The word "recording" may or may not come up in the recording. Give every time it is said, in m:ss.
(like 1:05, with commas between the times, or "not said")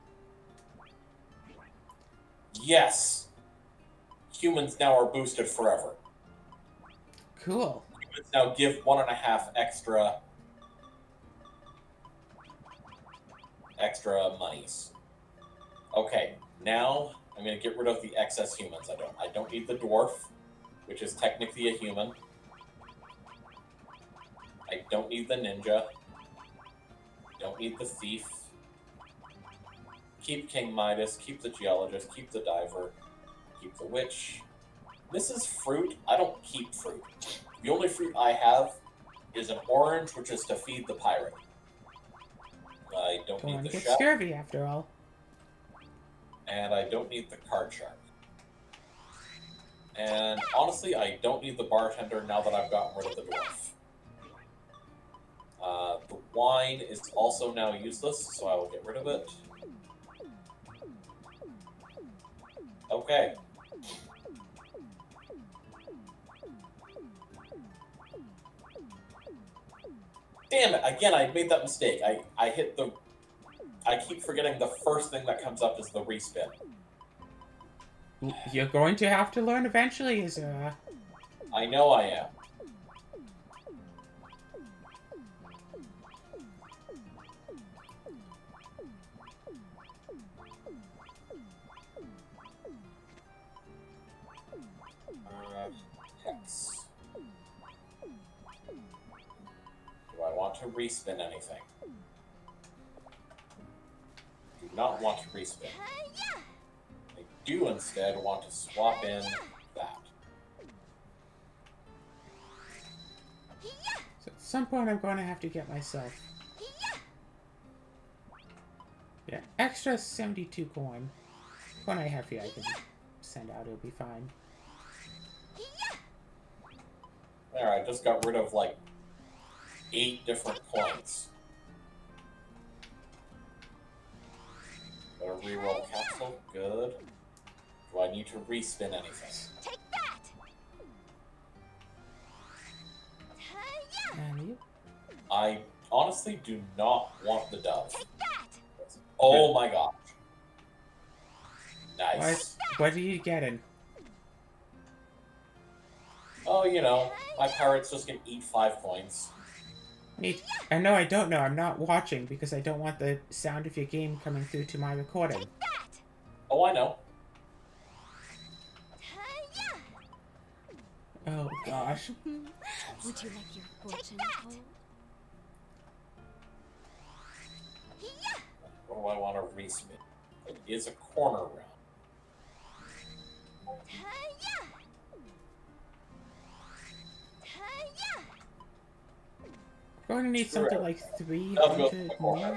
2:44.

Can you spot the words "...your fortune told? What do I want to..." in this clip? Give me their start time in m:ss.
2:53.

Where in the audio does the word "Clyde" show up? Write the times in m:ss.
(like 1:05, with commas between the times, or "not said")
not said.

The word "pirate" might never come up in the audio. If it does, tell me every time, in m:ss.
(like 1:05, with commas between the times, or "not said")
0:40, 2:37.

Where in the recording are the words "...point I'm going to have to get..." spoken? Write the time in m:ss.
1:54.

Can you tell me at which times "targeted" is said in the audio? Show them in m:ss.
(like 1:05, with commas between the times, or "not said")
not said.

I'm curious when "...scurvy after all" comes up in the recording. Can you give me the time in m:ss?
0:43.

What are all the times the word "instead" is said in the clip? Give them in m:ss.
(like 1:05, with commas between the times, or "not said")
1:47.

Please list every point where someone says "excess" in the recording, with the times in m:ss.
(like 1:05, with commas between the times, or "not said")
0:18.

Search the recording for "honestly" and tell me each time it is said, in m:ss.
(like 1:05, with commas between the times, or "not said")
0:50, 2:25.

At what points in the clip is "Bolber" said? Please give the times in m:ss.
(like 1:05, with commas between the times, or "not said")
not said.